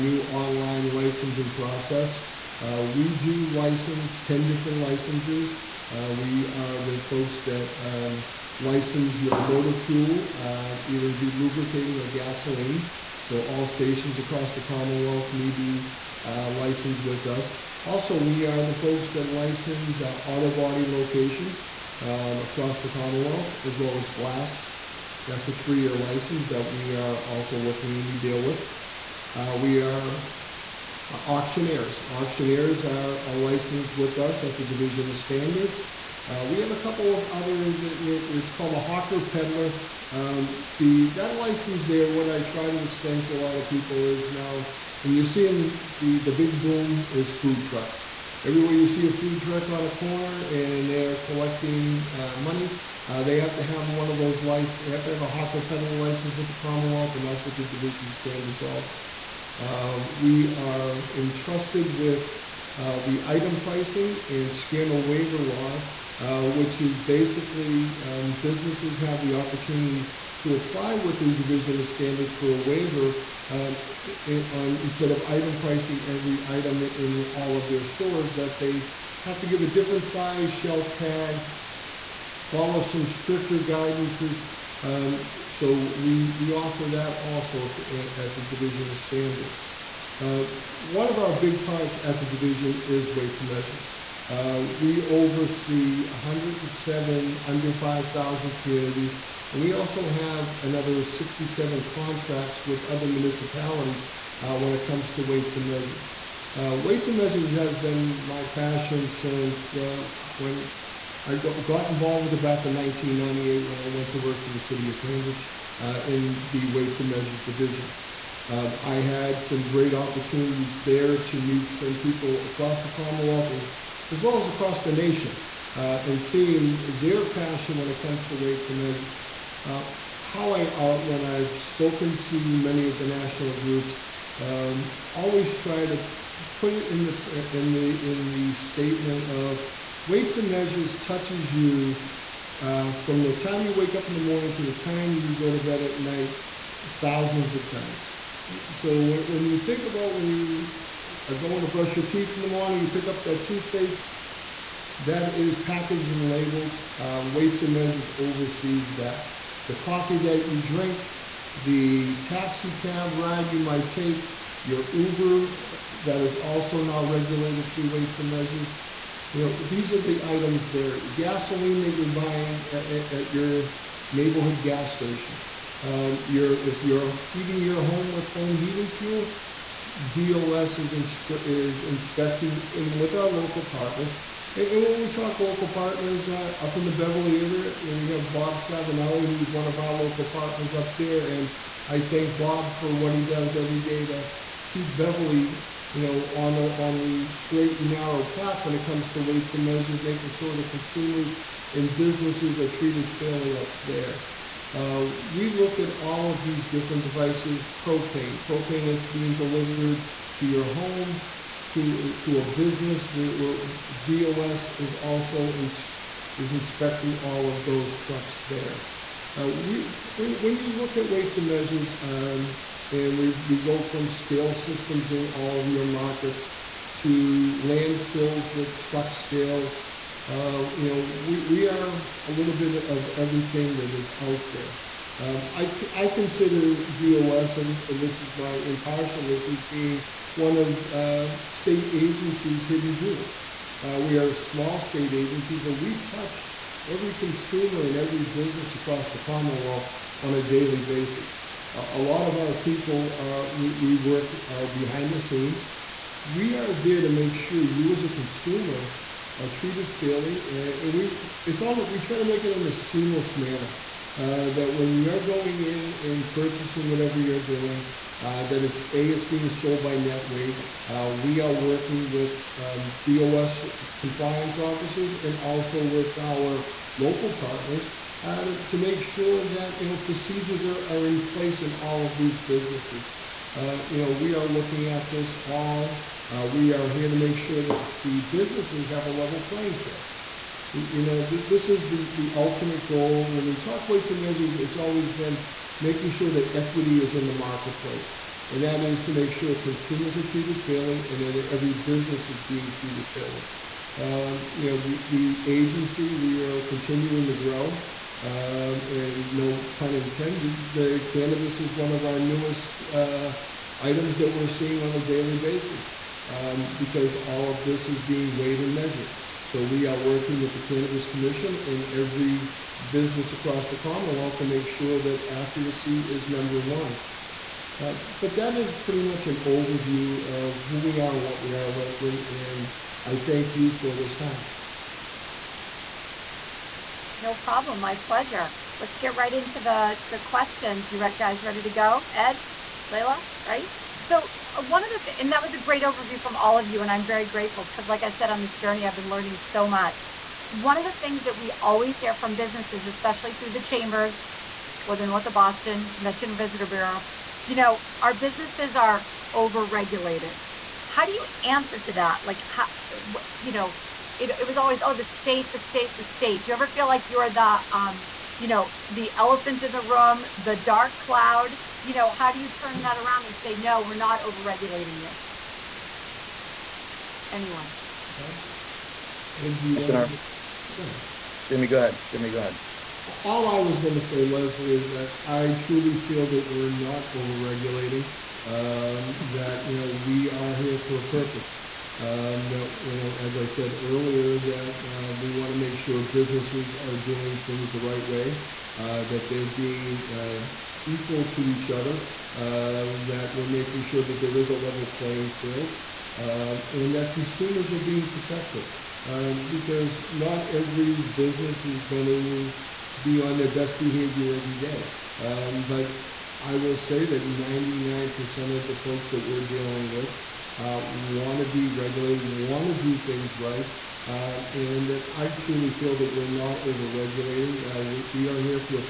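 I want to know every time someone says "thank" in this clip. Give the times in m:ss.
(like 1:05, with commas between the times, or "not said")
3:12, 5:33.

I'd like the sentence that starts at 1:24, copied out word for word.
Um, so we, we offer that also at the Division of Standards.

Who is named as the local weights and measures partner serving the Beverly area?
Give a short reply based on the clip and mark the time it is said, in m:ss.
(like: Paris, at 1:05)
Bob Savinelli, at 3:08.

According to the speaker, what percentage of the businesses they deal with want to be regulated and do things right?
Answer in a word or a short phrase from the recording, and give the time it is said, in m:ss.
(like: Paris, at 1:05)
99%, at 6:57.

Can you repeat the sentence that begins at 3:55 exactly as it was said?
Um, I, I consider DOS, and, and this is my impartialness, as being one of uh, state agencies' hidden jewels.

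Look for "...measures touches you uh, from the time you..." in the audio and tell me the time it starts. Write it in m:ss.
2:20.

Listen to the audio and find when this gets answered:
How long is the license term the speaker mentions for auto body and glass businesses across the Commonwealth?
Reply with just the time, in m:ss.
0:25.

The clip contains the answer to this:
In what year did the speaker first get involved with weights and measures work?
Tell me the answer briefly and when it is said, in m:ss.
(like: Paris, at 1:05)
1998, at 1:52.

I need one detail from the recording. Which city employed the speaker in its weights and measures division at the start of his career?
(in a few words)
Cambridge.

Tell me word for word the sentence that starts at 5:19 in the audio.
So we are working with the Cannabis Commission and every business across the Commonwealth to make sure that accuracy is number one.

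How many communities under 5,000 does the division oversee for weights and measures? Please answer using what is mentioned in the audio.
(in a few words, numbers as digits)
107.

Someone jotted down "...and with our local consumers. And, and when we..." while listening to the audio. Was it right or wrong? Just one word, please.
wrong.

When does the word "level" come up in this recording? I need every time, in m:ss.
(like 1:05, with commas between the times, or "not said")
4:49, 6:44.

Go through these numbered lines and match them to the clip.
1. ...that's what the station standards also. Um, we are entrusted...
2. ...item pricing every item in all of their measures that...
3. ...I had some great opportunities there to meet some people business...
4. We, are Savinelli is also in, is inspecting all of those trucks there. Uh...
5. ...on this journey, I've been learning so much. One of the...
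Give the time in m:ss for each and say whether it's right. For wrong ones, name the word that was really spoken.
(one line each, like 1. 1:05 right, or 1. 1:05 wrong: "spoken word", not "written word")
1. 0:57 wrong: "division", not "station"
2. 1:15 wrong: "stores", not "measures"
3. 1:58 wrong: "across", not "business"
4. 3:33 wrong: "DOS", not "Savinelli"
5. 5:48 right.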